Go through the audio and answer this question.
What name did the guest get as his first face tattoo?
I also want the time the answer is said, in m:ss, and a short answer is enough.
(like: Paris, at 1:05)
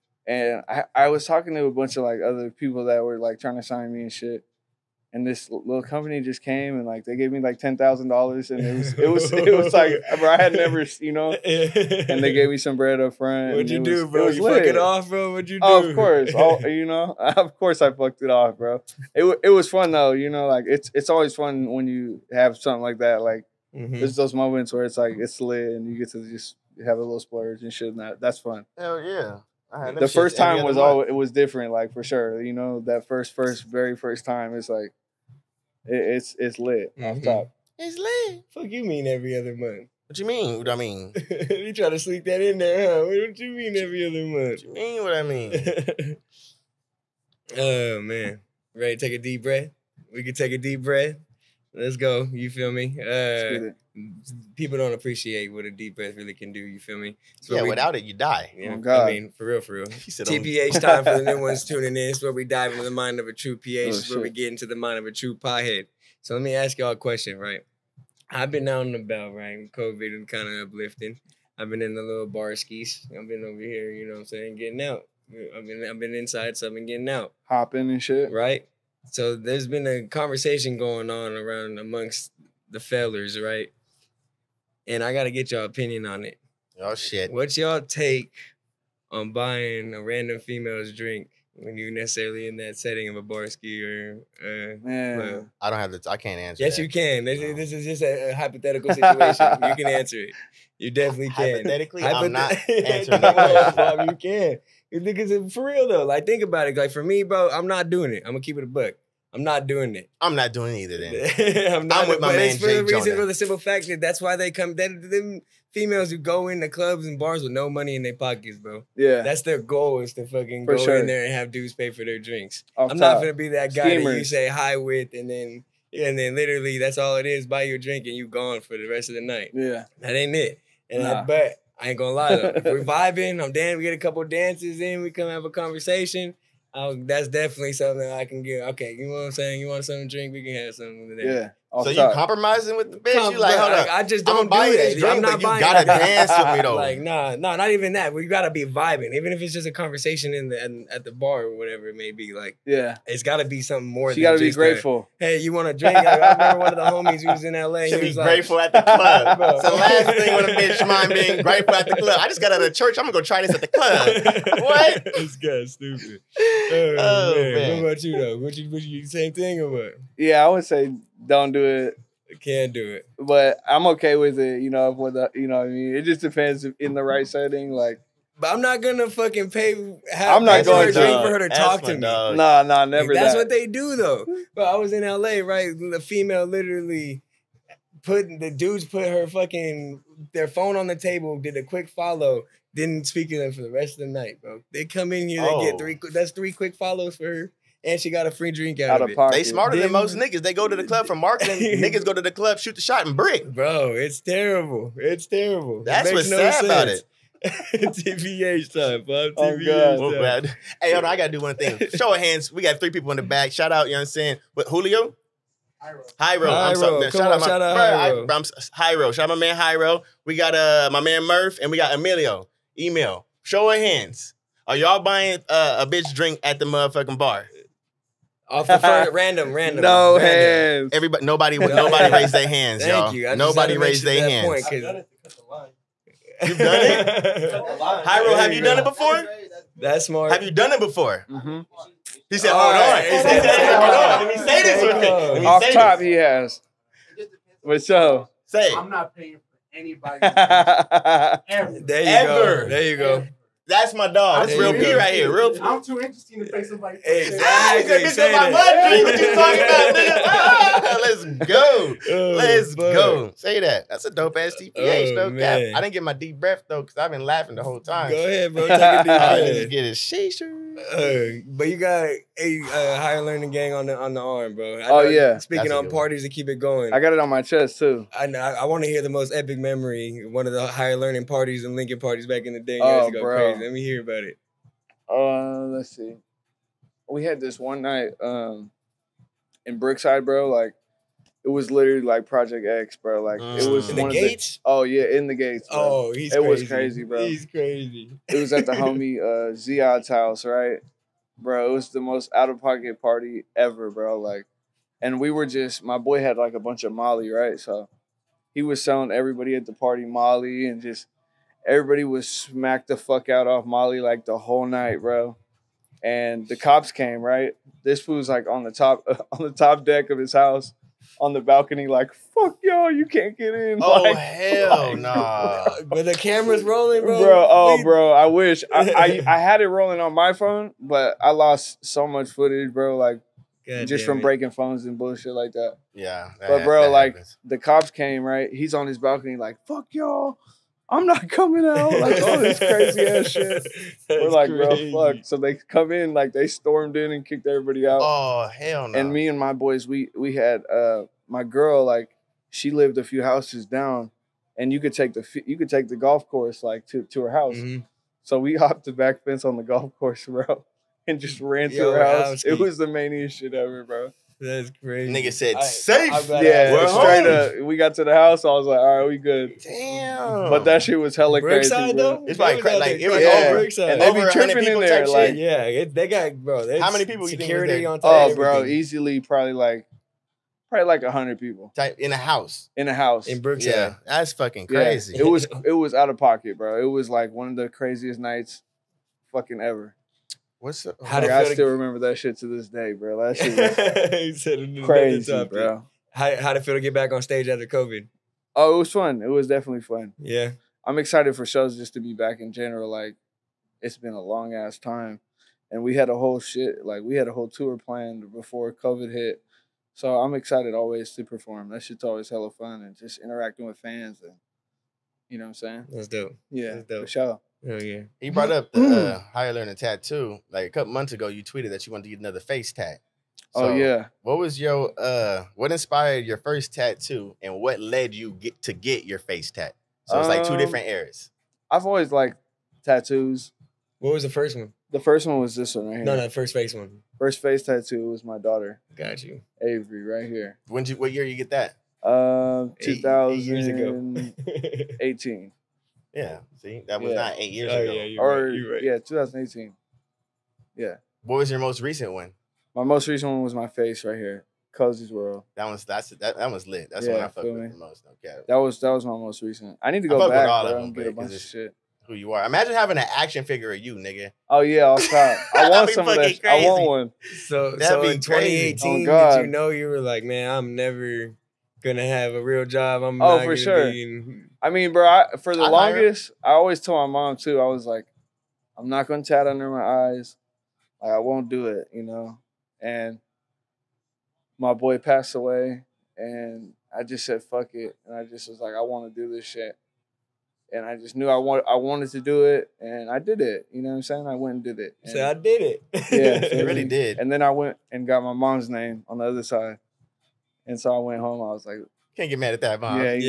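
Avery, at 7:19.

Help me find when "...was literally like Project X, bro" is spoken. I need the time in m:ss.
4:51.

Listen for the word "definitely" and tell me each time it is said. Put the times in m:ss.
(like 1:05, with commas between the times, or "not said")
1:40, 2:17, 6:39.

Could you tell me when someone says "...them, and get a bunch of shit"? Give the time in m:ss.
7:40.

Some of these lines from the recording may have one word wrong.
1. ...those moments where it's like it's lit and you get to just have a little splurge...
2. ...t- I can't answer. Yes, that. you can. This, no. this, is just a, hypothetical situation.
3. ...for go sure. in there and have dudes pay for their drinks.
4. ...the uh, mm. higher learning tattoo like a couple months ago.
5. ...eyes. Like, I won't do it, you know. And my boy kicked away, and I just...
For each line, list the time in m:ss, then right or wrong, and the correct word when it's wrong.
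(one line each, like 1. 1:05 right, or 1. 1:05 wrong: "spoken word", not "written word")
1. 0:24 right
2. 1:35 right
3. 2:00 right
4. 6:58 right
5. 8:00 wrong: "passed", not "kicked".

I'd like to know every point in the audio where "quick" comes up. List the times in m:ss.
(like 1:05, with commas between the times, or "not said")
3:11, 3:16.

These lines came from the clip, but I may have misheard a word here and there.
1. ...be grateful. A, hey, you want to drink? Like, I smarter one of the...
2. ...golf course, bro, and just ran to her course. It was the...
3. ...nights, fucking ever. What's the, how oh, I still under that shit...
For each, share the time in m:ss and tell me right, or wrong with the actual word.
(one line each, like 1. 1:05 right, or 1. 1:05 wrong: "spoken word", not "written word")
1. 2:34 wrong: "remember", not "smarter"
2. 5:59 wrong: "house", not "course"
3. 6:28 wrong: "remember", not "under".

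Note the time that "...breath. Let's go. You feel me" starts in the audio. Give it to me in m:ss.
0:50.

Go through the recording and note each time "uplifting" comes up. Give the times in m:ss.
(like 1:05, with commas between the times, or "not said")
1:10.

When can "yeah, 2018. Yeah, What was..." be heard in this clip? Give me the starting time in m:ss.
7:28.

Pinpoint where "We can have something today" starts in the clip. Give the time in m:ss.
2:20.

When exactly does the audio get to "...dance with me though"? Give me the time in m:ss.
2:25.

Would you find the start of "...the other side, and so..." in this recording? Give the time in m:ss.
8:19.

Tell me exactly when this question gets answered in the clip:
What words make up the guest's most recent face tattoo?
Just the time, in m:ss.
7:34.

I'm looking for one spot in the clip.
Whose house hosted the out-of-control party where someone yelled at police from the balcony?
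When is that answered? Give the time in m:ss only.
4:59.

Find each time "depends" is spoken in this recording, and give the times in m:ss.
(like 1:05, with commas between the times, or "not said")
2:56.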